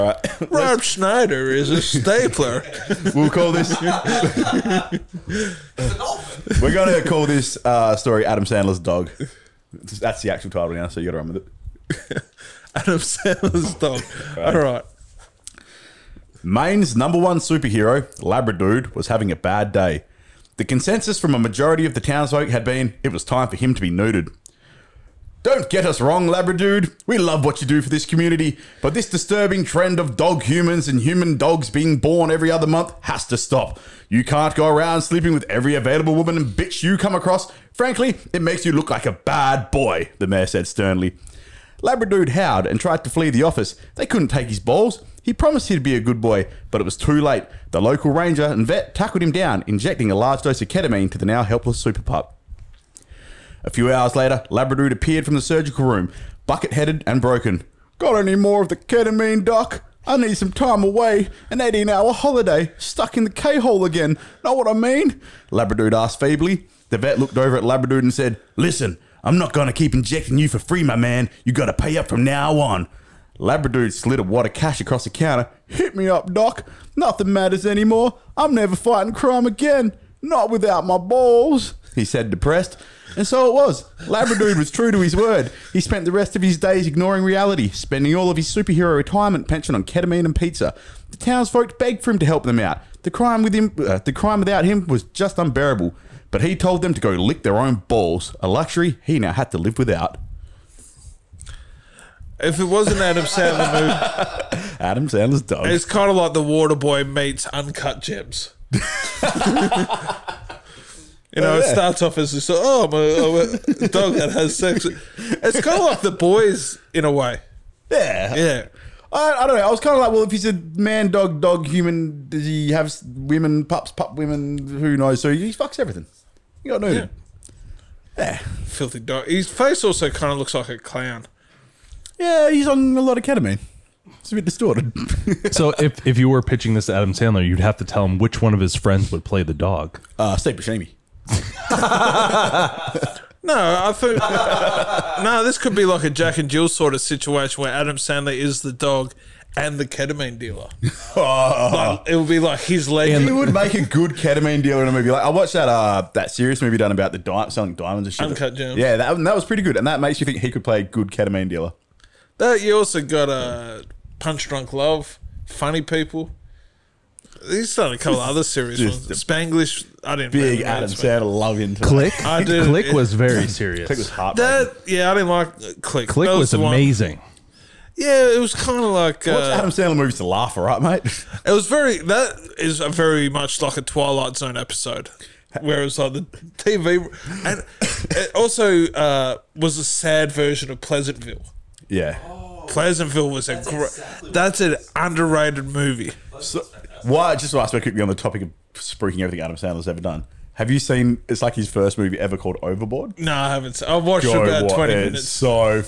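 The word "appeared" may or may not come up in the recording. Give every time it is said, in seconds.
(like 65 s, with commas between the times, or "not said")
54 s.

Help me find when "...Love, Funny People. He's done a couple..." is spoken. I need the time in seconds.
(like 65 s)
164 s.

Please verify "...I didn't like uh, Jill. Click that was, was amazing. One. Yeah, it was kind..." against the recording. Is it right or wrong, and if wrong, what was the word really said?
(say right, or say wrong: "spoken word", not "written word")
wrong: "Click", not "Jill".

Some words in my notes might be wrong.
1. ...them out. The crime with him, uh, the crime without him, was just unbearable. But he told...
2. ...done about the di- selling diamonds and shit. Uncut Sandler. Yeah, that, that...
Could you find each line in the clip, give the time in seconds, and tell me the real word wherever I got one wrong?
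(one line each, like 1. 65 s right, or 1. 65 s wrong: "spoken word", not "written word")
1. 92 s right
2. 156 s wrong: "Gems", not "Sandler".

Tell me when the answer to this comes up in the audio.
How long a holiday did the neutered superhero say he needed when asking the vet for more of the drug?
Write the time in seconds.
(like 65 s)
61 s.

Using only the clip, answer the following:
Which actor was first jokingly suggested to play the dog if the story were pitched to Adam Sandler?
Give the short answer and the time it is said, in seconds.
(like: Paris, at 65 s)
Steve Buscemi, at 140 s.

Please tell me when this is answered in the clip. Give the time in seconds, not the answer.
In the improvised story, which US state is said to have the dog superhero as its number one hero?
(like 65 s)
16 s.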